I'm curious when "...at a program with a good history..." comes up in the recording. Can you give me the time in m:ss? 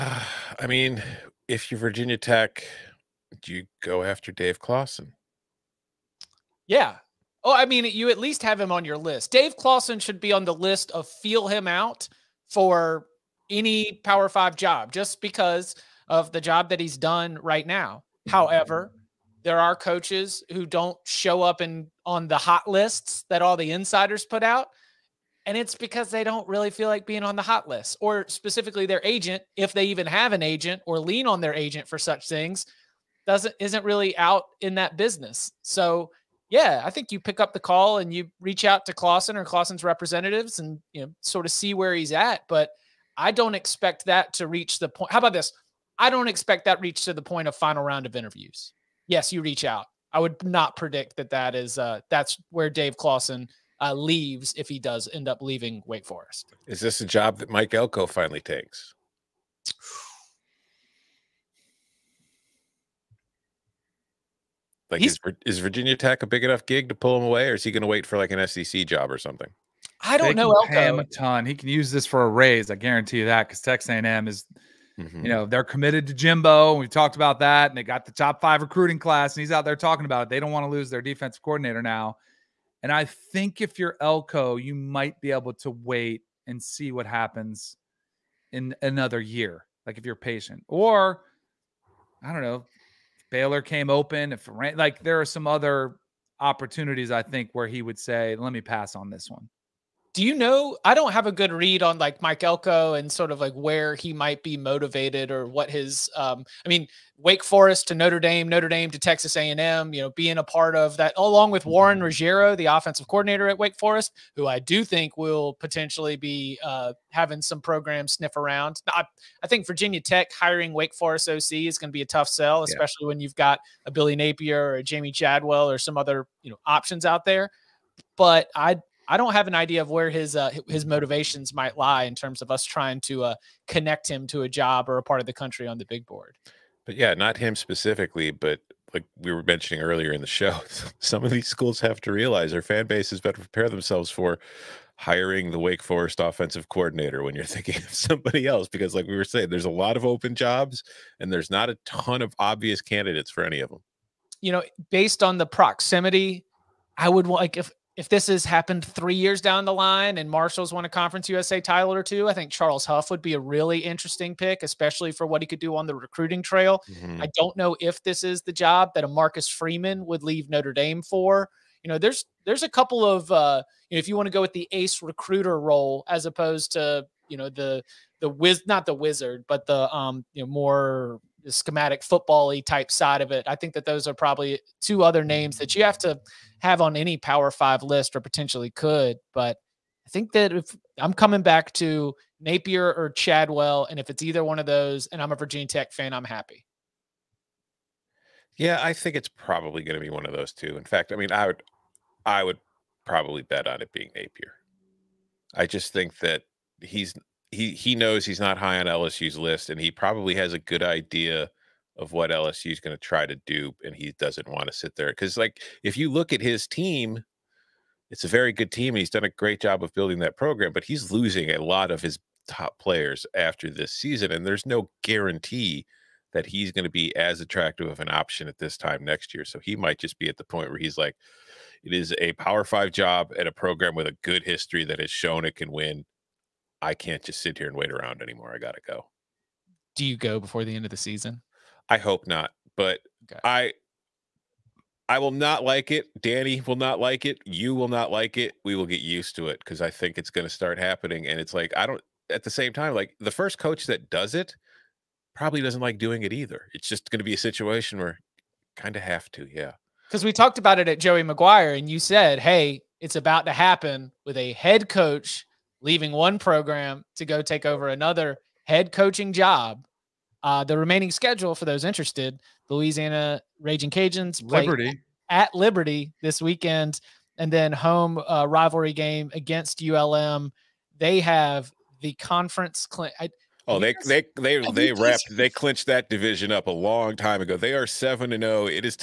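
3:53.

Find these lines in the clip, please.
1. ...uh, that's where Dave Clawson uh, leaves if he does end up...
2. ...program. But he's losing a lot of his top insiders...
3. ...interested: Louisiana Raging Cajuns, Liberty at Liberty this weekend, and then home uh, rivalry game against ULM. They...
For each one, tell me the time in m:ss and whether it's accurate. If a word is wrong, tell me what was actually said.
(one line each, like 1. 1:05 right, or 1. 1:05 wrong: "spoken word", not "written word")
1. 0:51 right
2. 3:40 wrong: "players", not "insiders"
3. 4:31 right.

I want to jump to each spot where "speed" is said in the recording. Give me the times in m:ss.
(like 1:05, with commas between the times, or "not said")
not said.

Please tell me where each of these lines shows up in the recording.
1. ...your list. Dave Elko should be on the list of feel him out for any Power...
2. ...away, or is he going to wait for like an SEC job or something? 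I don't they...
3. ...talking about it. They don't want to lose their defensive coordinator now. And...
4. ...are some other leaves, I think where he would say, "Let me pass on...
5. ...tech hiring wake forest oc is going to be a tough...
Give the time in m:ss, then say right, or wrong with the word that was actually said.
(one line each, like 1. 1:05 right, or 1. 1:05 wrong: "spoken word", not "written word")
1. 0:08 wrong: "Clawson", not "Elko"
2. 1:07 right
3. 1:19 right
4. 1:35 wrong: "opportunities", not "leaves"
5. 2:00 right.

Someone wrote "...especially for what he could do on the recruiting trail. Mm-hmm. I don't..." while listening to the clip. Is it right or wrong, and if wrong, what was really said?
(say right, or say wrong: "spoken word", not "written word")
right.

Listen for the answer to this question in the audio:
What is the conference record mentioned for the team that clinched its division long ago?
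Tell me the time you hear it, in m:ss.
4:47.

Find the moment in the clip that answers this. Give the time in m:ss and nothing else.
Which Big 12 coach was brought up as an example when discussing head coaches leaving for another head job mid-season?
4:20.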